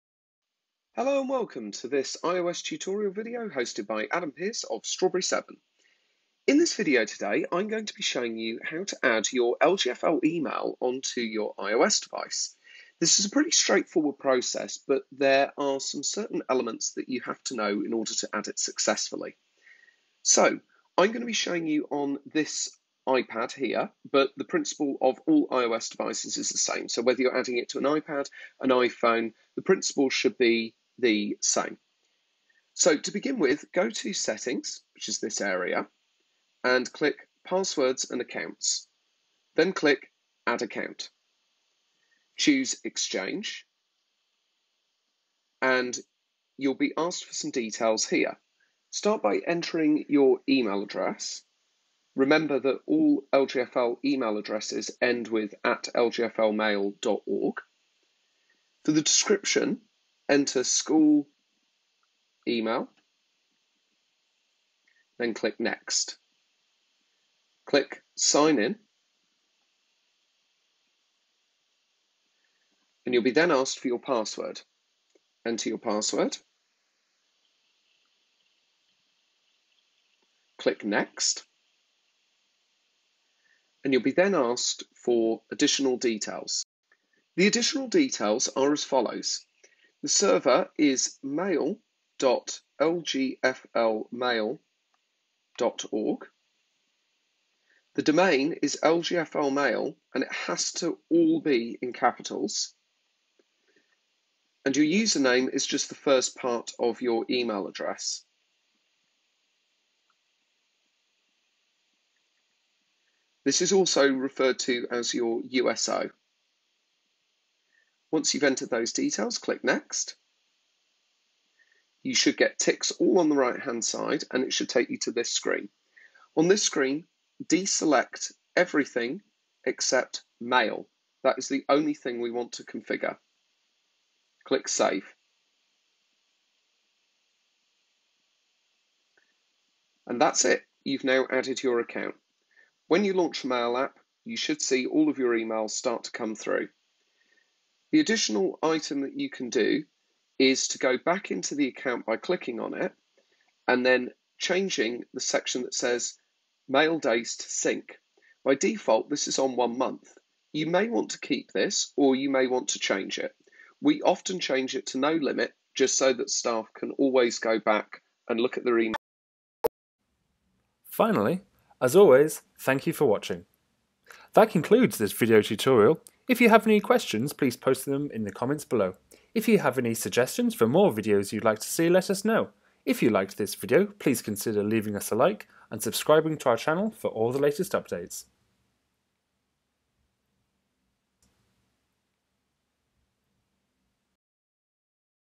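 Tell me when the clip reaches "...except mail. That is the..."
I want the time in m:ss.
2:09.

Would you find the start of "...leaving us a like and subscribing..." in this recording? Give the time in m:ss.
3:04.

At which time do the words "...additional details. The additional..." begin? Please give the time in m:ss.
1:25.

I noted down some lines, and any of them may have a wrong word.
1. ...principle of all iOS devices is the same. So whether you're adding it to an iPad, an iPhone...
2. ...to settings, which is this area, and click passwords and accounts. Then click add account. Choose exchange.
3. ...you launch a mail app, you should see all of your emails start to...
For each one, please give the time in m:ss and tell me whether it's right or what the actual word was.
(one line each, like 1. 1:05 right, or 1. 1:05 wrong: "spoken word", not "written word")
1. 0:24 right
2. 0:33 right
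3. 2:23 right.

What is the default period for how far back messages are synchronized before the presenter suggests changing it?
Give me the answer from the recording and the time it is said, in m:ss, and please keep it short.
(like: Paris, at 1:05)
One month, at 2:39.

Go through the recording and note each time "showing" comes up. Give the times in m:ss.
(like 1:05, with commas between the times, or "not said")
0:08, 0:21.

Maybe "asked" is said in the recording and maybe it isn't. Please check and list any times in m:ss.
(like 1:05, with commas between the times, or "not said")
0:46, 1:13, 1:24.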